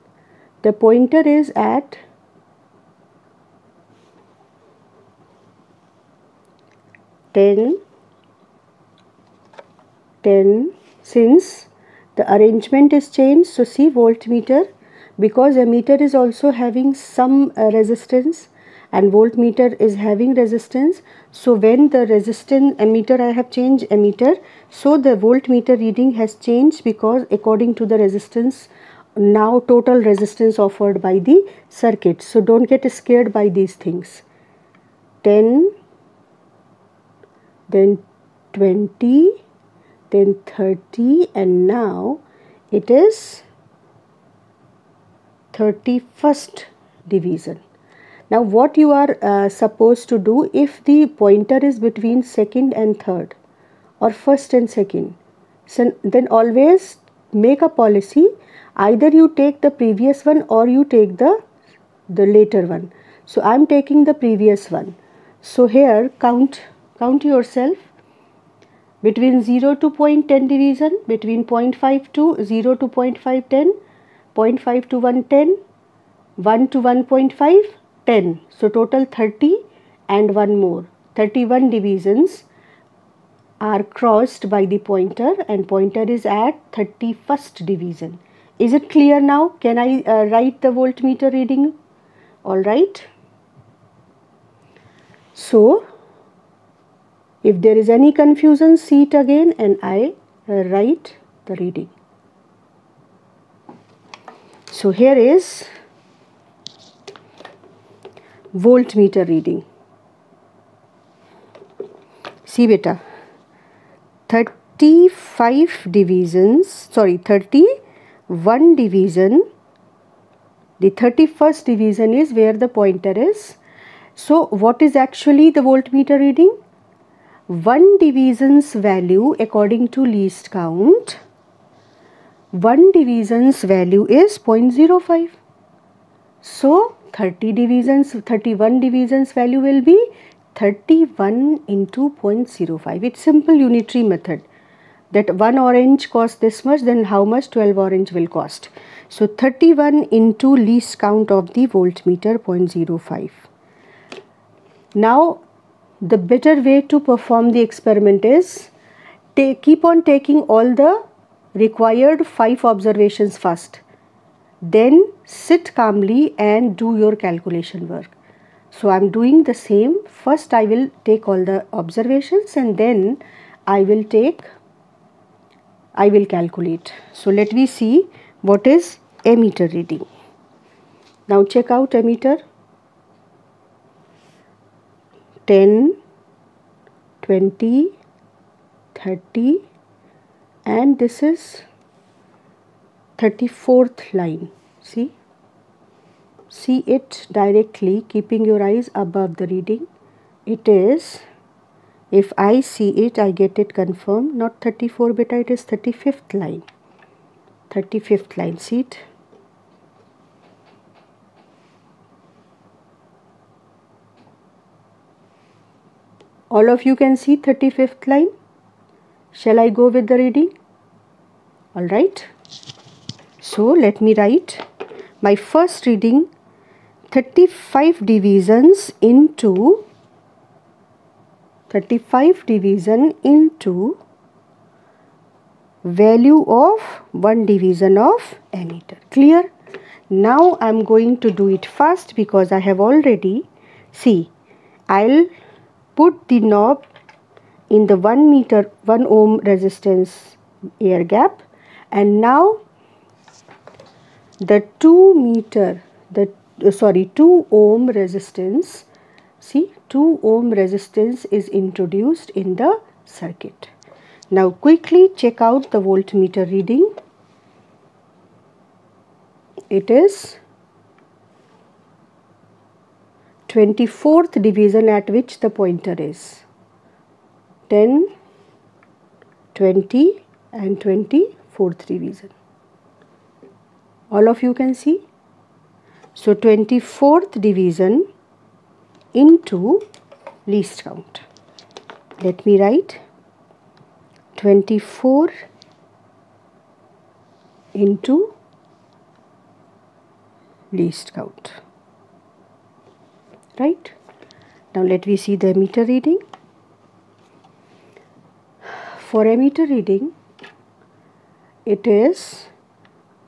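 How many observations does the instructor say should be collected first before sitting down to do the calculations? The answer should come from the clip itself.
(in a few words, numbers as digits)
5.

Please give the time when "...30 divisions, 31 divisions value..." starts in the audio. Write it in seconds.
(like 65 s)
137 s.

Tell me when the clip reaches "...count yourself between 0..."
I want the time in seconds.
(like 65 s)
66 s.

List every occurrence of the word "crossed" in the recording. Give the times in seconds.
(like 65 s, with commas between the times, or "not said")
83 s.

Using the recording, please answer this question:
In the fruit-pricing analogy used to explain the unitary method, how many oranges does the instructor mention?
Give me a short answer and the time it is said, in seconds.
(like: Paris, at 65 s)
12, at 147 s.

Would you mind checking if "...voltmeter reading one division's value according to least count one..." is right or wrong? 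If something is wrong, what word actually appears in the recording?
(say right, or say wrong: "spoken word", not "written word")
right.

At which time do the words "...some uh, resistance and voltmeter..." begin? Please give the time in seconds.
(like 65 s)
16 s.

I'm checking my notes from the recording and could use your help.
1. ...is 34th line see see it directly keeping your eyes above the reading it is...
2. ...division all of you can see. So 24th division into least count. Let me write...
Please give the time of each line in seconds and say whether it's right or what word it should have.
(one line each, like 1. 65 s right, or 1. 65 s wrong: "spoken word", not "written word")
1. 191 s right
2. 281 s right.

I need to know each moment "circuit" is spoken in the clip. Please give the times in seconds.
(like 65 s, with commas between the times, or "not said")
31 s, 263 s.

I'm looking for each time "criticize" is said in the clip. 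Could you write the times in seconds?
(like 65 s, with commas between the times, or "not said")
not said.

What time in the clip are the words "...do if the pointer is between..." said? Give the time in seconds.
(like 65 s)
50 s.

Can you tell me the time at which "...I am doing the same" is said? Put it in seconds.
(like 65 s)
168 s.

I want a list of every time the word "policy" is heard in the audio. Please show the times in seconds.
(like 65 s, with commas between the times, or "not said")
57 s.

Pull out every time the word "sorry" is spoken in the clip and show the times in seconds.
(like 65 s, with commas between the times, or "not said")
116 s, 256 s.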